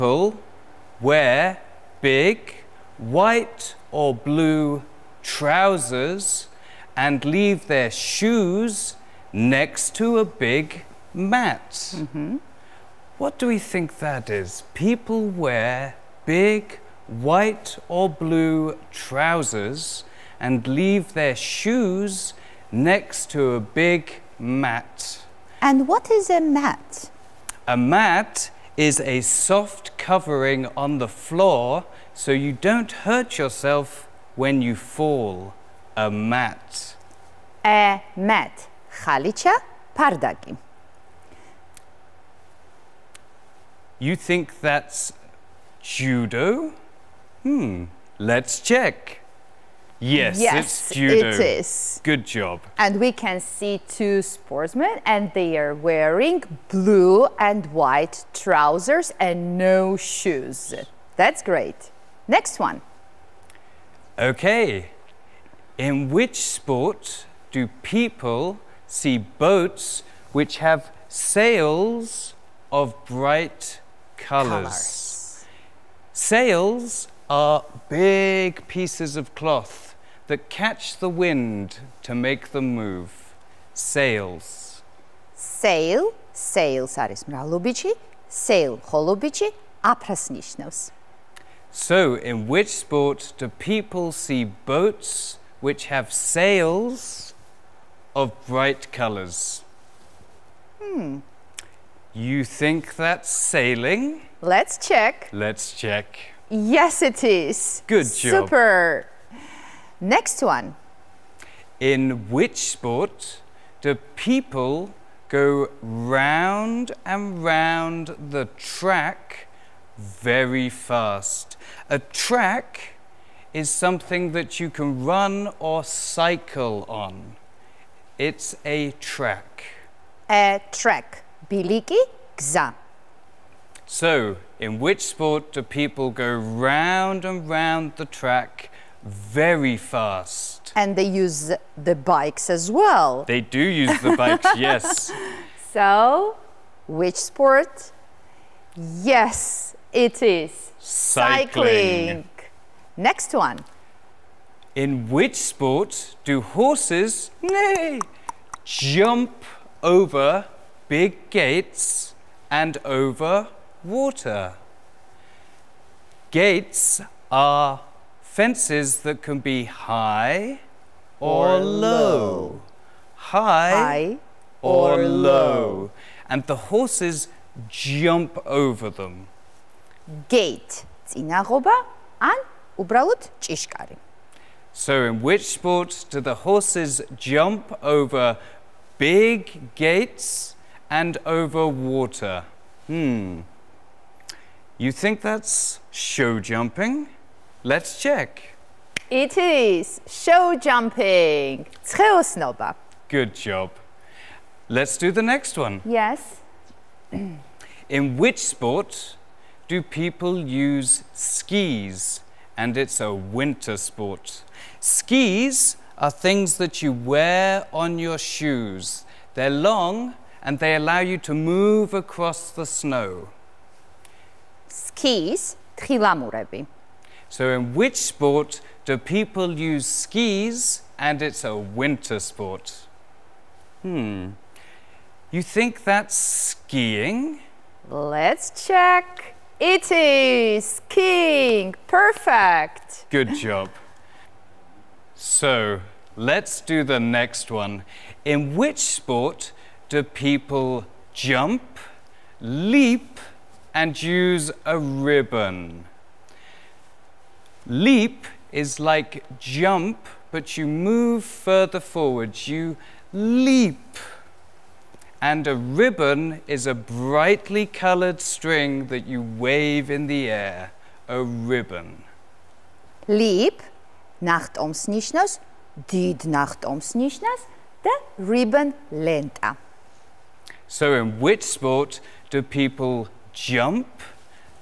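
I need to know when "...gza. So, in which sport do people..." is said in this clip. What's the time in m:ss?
2:12.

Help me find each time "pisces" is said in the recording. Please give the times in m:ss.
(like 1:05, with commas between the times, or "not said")
not said.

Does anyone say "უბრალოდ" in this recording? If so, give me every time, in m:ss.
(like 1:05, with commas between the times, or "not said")
3:02.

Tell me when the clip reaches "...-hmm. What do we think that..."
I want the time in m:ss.
0:12.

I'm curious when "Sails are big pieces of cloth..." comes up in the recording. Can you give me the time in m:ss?
1:16.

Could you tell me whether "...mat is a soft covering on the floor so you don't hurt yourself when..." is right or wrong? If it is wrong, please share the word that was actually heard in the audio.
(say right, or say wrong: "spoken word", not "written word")
right.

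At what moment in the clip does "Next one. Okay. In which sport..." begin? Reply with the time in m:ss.
1:02.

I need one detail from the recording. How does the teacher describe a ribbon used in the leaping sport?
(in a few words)
brightly colored string.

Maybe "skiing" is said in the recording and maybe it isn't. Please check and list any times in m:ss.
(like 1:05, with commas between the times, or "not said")
3:56, 4:00.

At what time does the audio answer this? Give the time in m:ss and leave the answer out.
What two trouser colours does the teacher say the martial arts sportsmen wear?
0:56.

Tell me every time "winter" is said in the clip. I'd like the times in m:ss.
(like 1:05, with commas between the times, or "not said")
3:33, 3:51.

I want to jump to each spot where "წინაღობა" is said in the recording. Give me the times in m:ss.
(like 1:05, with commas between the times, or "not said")
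3:01.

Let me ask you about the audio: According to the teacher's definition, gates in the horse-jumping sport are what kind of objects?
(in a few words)
Fences.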